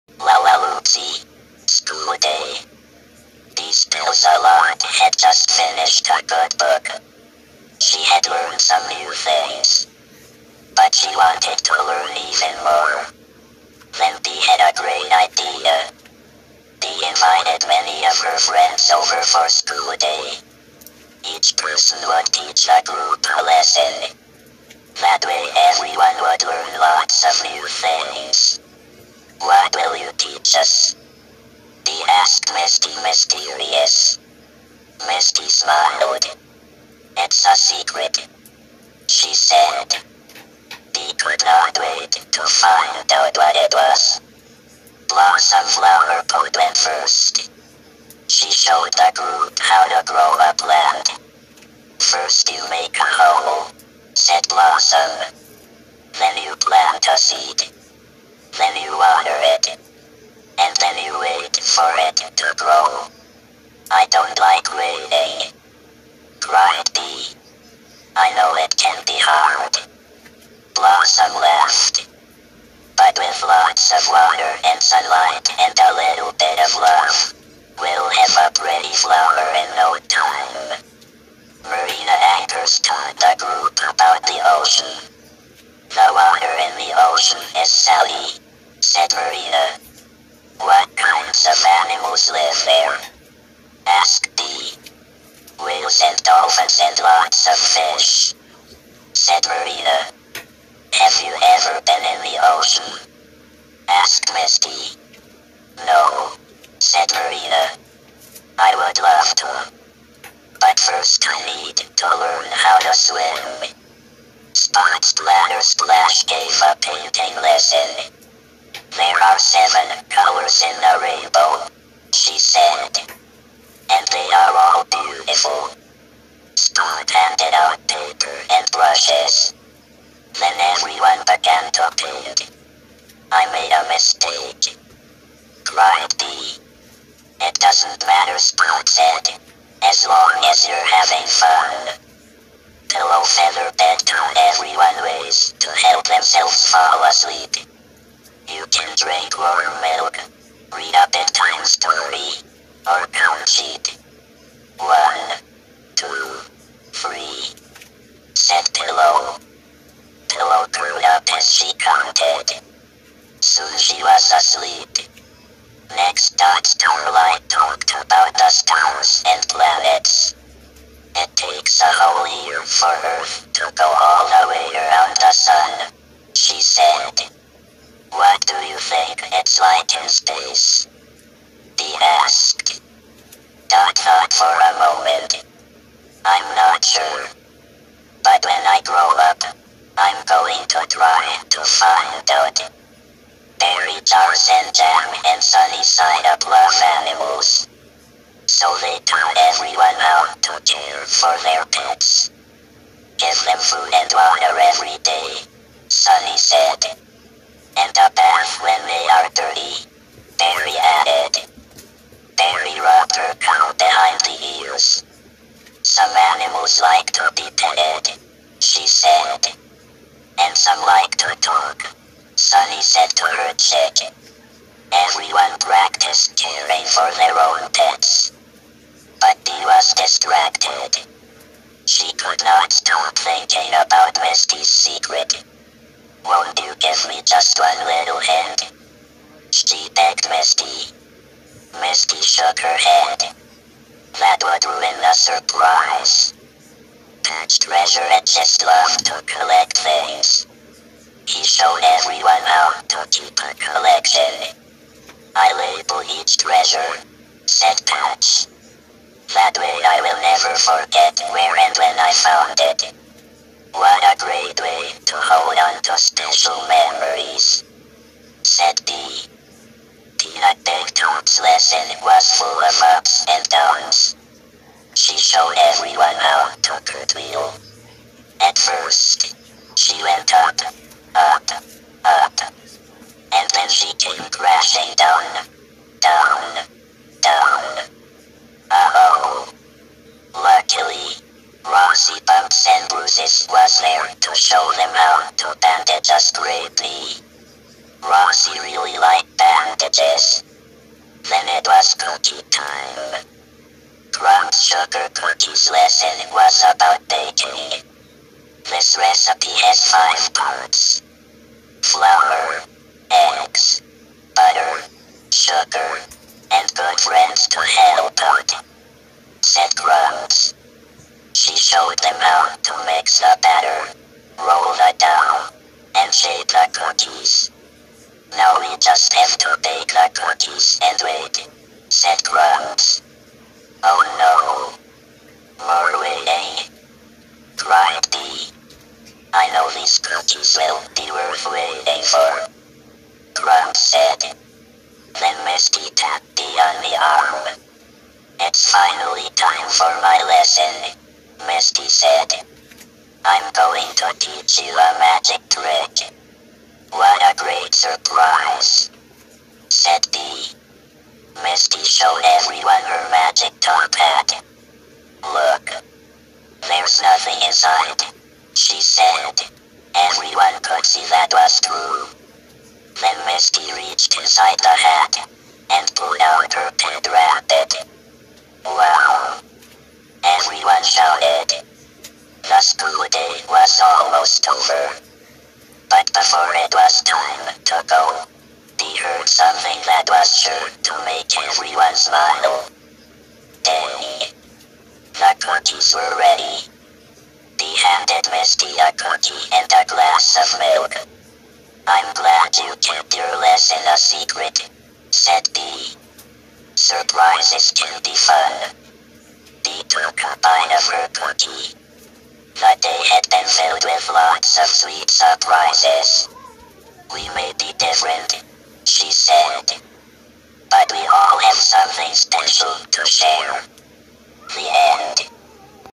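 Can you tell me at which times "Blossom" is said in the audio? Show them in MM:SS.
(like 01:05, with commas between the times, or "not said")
00:45, 00:54, 01:10.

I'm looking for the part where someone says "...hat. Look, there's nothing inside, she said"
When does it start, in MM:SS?
06:03.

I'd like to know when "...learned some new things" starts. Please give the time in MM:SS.
00:08.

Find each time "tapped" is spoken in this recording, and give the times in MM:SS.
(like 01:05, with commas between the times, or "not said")
05:45.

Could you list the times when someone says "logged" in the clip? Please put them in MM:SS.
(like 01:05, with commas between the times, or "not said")
not said.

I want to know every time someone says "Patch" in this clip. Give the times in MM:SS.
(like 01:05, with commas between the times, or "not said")
04:07, 04:17.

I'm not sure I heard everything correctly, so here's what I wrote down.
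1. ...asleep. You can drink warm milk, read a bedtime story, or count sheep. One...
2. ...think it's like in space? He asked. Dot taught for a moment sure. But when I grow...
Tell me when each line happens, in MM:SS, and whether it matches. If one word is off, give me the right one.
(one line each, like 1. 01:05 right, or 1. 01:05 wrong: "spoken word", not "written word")
1. 02:27 right
2. 02:58 wrong: "thought", not "taught".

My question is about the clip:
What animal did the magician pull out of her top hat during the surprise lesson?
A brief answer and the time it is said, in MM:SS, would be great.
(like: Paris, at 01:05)
her pet rabbit, at 06:16.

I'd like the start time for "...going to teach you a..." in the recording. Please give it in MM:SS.
05:53.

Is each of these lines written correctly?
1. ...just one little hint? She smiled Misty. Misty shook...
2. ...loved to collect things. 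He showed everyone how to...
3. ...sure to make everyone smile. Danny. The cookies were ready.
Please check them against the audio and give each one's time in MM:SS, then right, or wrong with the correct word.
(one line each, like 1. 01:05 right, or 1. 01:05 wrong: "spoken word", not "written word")
1. 03:57 wrong: "begged", not "smiled"
2. 04:08 right
3. 06:30 right.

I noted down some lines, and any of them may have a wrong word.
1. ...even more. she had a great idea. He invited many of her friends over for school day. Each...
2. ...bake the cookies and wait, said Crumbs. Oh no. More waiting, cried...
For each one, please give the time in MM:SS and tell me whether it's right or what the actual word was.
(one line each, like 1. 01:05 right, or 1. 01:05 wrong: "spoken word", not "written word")
1. 00:12 right
2. 05:29 right.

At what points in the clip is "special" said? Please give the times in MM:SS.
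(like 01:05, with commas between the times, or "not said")
04:25, 07:02.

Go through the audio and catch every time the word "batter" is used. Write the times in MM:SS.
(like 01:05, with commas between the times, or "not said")
05:23.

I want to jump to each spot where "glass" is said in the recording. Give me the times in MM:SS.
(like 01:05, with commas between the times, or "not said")
06:39.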